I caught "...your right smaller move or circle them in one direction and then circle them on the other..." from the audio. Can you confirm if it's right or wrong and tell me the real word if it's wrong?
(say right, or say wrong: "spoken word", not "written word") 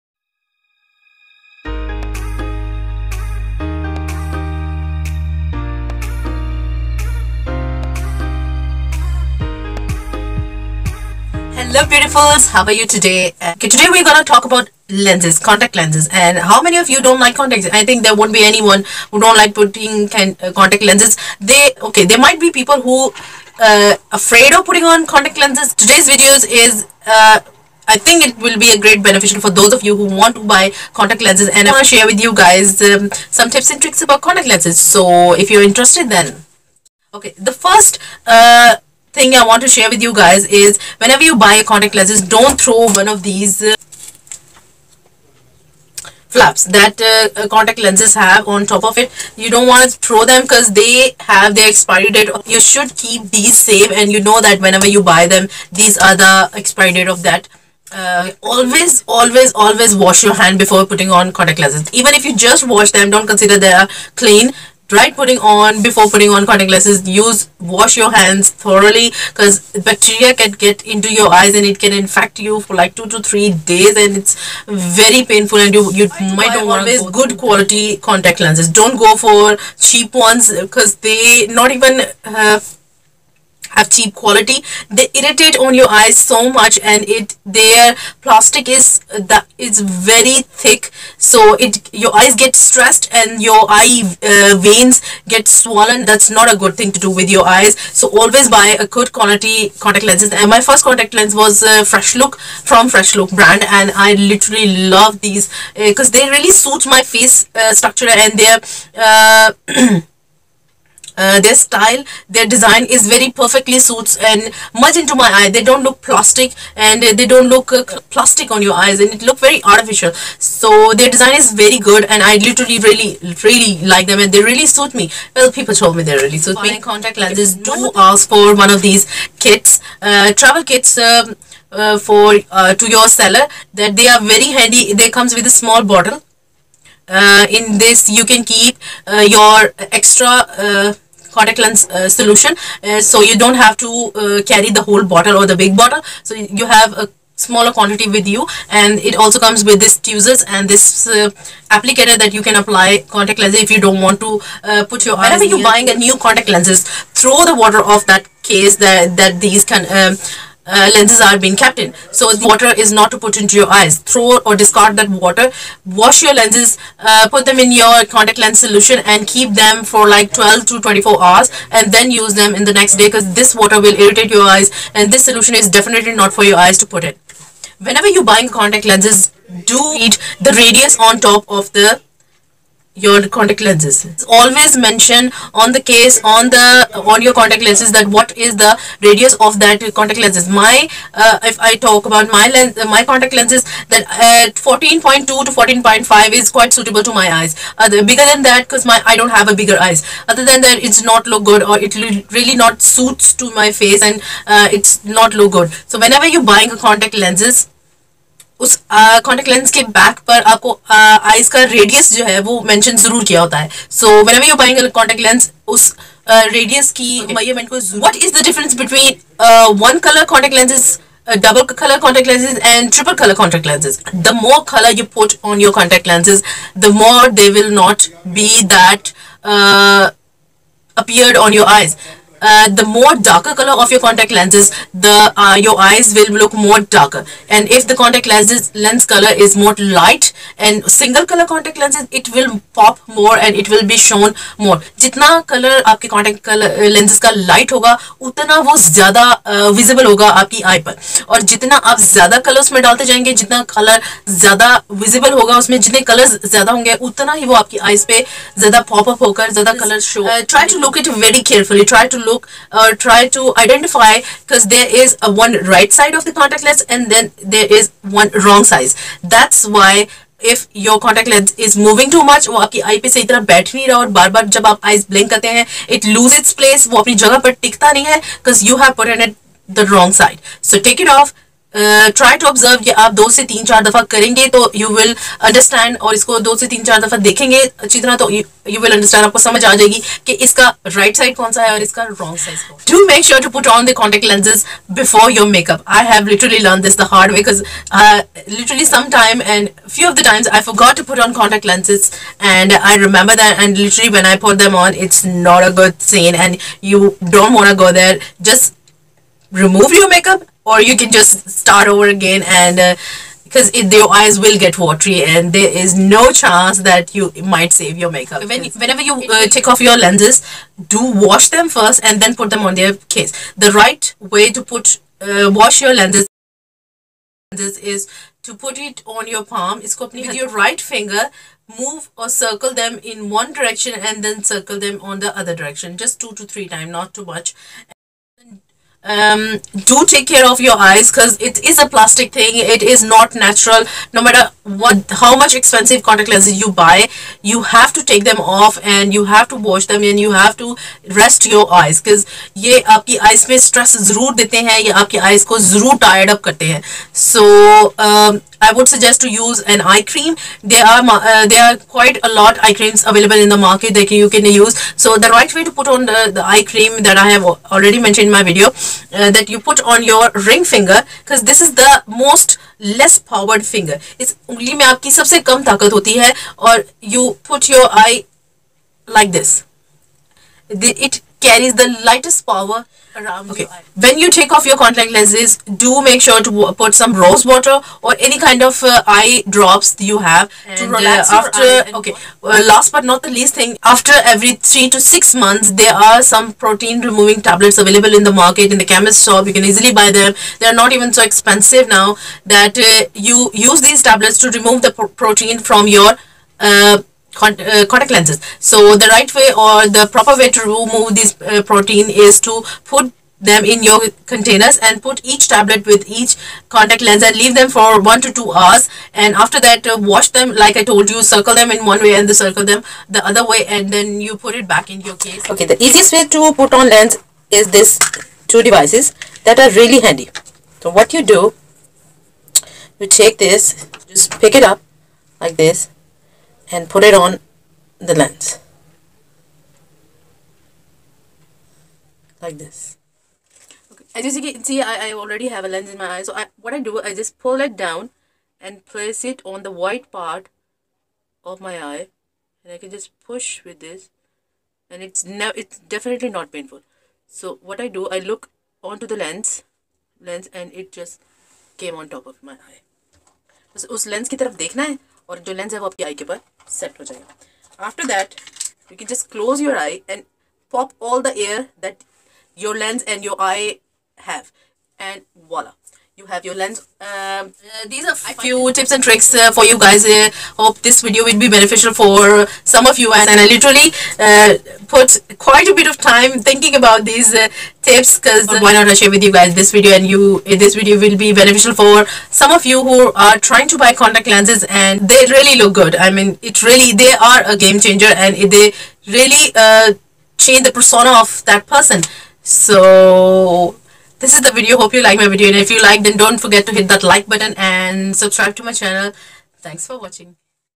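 wrong: "finger", not "smaller".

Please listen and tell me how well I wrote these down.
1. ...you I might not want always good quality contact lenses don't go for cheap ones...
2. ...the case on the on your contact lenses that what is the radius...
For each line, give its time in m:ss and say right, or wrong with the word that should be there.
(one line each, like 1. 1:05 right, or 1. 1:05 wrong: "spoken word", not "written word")
1. 1:15 right
2. 3:05 right.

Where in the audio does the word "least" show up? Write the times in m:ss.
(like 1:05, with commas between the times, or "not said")
6:33.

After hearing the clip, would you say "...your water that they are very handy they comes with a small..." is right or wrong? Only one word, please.
wrong.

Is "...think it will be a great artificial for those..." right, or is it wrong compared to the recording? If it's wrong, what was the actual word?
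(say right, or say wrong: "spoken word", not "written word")
wrong: "beneficial", not "artificial".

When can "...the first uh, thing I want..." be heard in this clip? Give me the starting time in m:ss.
0:37.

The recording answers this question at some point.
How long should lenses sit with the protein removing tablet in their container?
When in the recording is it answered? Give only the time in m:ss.
6:57.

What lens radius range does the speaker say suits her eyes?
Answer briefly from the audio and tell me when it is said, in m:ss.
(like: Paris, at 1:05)
14.2 to 14.5, at 3:14.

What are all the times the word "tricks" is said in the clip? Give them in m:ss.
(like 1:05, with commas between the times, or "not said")
0:33, 7:59.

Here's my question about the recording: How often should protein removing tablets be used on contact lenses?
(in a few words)
every 3 to 6 months.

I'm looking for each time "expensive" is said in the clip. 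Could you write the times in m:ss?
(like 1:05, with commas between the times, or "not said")
5:45, 6:41.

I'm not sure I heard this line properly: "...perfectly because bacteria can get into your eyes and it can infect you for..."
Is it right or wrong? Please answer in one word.
wrong.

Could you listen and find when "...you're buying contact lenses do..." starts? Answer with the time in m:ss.
2:58.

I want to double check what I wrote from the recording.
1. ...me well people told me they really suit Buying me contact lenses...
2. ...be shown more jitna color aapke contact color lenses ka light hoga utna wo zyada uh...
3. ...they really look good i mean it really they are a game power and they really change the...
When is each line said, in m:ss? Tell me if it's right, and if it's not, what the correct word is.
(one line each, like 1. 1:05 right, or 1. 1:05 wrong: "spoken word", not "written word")
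1. 2:04 right
2. 4:03 right
3. 8:15 wrong: "changer", not "power".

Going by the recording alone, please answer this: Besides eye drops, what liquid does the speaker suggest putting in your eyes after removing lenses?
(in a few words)
rose water.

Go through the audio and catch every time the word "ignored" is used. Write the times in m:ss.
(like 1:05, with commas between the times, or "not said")
not said.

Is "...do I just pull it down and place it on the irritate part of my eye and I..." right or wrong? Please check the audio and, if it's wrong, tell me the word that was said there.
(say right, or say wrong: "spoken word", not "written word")
wrong: "white", not "irritate".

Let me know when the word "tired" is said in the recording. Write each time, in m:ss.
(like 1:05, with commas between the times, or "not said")
5:56.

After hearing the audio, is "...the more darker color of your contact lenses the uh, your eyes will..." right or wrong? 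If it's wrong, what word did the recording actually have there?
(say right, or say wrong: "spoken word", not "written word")
right.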